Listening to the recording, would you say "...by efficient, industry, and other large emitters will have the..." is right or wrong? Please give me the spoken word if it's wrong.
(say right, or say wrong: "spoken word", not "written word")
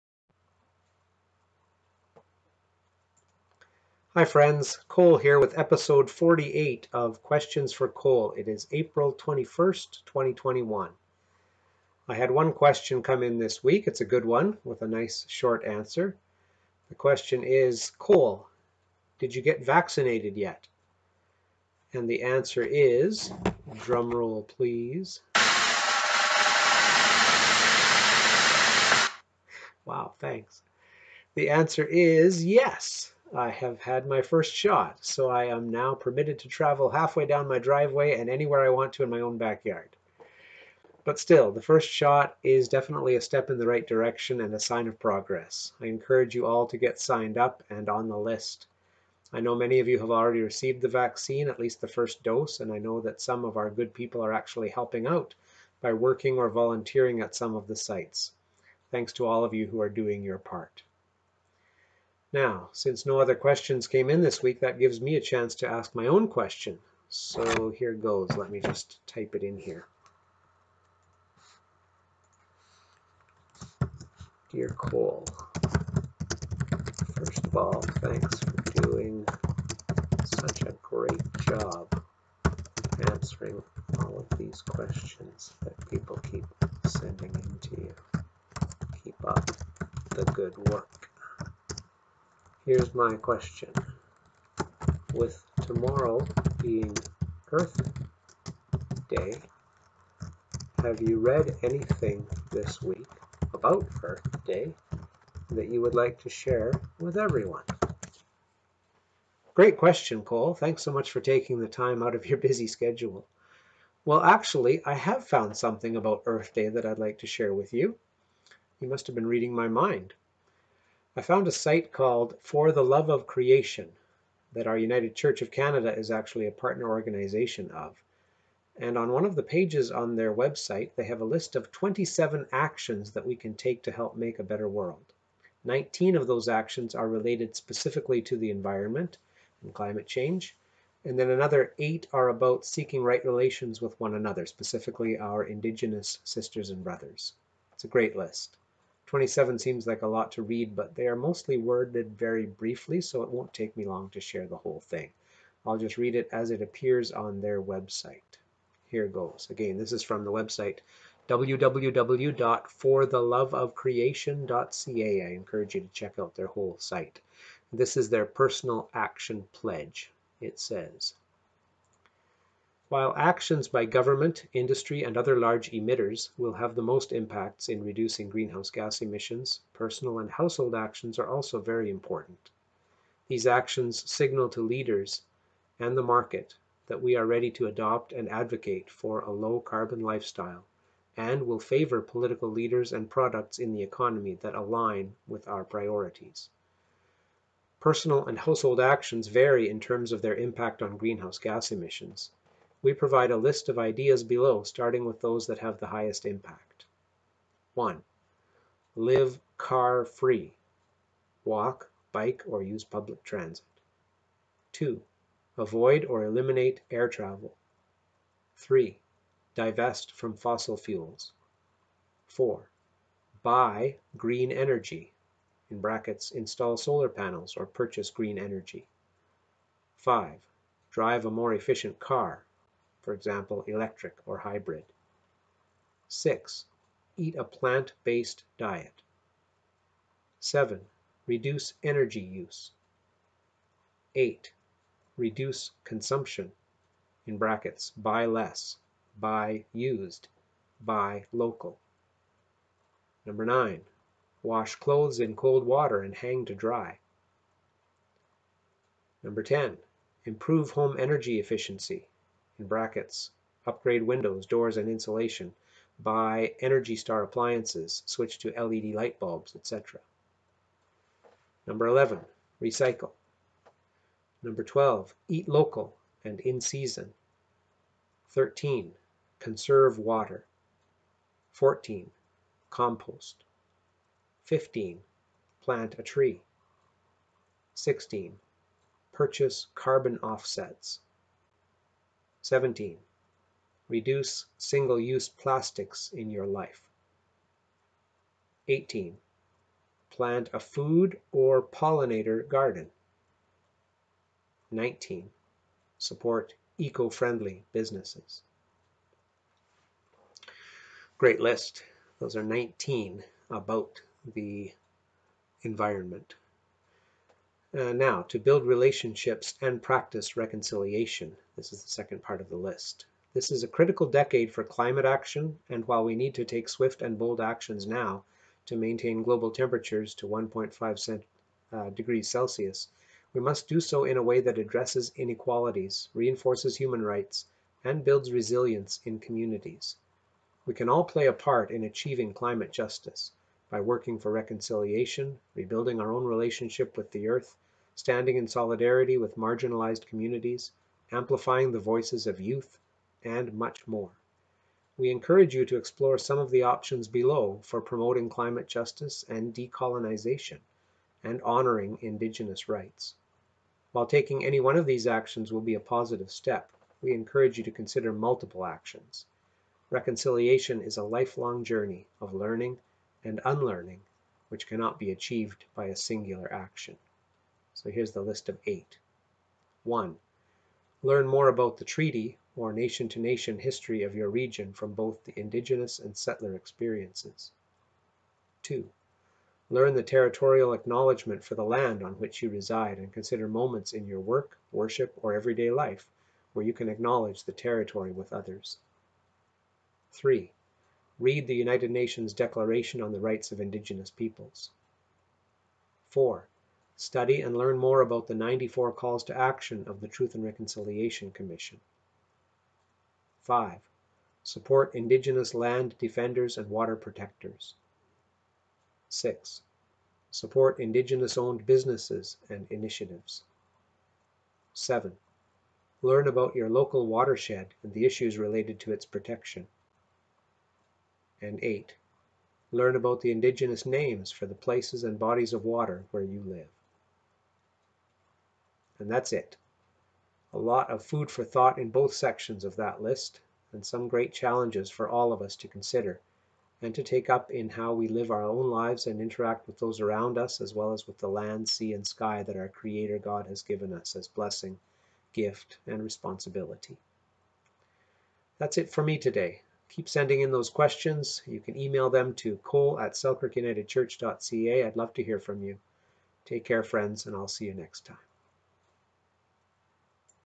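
wrong: "government", not "efficient".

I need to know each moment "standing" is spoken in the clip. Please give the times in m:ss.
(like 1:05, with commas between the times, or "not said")
5:47.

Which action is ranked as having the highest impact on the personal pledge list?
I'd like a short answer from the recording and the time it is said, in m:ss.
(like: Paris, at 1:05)
Live car free, at 3:28.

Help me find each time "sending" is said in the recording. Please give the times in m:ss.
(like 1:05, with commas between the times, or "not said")
1:26, 7:40.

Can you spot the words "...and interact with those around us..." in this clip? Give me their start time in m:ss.
7:29.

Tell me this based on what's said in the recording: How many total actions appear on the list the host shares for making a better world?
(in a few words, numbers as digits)
27.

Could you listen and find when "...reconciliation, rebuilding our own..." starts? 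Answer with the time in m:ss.
5:44.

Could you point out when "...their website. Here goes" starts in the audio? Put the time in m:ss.
2:37.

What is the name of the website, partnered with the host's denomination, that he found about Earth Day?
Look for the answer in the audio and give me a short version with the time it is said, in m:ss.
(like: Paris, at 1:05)
For the Love of Creation, at 2:02.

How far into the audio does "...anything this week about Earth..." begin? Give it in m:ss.
1:41.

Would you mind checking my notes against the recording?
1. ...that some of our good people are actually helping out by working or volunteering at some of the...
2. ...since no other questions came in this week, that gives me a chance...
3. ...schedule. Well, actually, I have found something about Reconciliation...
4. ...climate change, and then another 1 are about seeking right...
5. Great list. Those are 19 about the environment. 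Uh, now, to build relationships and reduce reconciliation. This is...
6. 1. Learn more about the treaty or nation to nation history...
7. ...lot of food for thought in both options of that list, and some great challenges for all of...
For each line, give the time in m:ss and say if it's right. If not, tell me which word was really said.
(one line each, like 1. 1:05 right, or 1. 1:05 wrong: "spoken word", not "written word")
1. 0:52 right
2. 1:02 right
3. 1:52 wrong: "Earth", not "Reconciliation"
4. 2:19 wrong: "8", not "1"
5. 5:11 wrong: "practice", not "reduce"
6. 6:19 right
7. 7:20 wrong: "sections", not "options".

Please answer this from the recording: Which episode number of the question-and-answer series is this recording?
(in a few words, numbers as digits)
48.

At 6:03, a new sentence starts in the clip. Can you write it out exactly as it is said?
While taking any one of these actions will be a positive step, we encourage you to consider multiple actions.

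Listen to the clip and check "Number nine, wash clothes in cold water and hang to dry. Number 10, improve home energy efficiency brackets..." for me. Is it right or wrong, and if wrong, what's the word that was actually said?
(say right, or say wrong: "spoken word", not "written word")
right.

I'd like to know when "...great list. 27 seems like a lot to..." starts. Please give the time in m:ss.
2:27.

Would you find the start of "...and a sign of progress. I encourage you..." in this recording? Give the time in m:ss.
0:44.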